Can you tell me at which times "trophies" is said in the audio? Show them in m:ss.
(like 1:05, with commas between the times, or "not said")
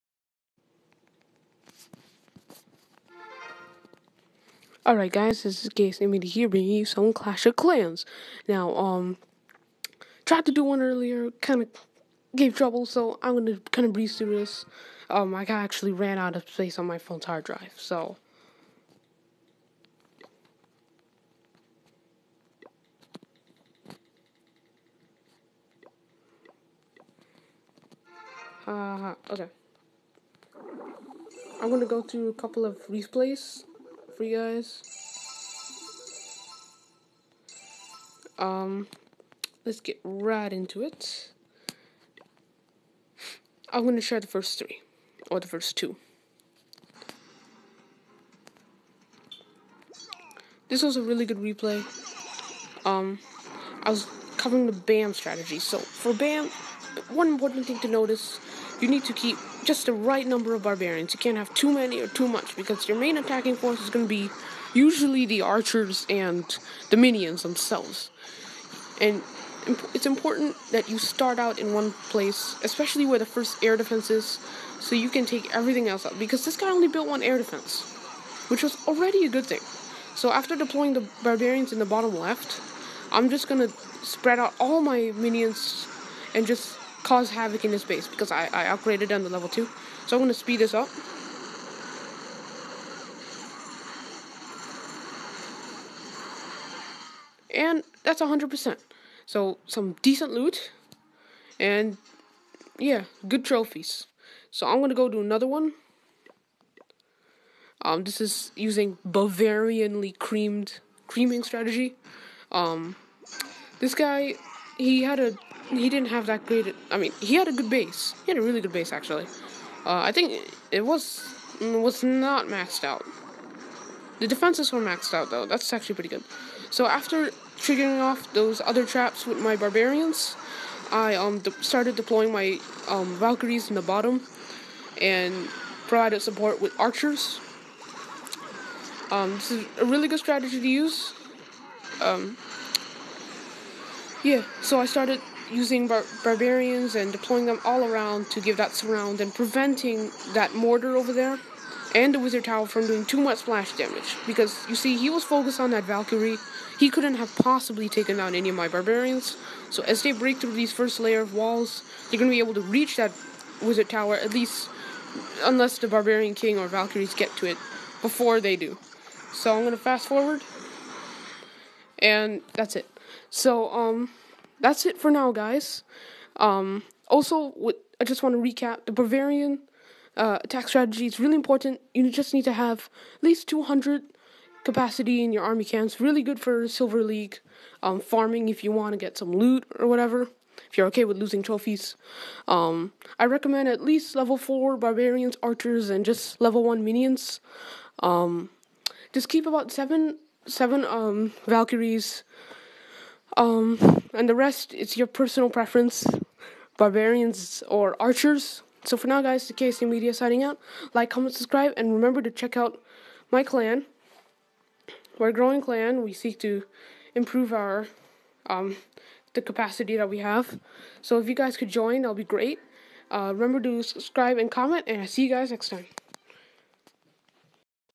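1:43, 3:11.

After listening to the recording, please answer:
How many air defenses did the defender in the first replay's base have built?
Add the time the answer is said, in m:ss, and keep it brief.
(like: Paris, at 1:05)
1, at 1:17.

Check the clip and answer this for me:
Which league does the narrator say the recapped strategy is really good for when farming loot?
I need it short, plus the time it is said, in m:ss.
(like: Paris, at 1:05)
Silver League, at 3:06.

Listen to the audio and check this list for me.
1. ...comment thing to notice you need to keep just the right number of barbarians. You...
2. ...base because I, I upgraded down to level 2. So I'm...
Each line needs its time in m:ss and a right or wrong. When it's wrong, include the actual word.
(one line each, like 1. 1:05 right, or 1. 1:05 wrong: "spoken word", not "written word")
1. 0:57 wrong: "important", not "comment"
2. 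1:27 right.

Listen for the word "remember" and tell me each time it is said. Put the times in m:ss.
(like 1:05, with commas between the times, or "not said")
3:31, 3:43.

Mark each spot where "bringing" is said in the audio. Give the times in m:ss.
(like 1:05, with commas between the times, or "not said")
0:06.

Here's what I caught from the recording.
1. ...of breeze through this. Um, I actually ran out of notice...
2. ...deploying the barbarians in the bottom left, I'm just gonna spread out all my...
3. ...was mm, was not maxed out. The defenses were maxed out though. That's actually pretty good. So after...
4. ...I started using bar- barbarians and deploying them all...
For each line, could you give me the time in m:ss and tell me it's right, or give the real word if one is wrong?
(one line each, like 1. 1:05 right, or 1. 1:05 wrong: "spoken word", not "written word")
1. 0:13 wrong: "space", not "notice"
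2. 1:20 right
3. 2:00 right
4. 2:24 right.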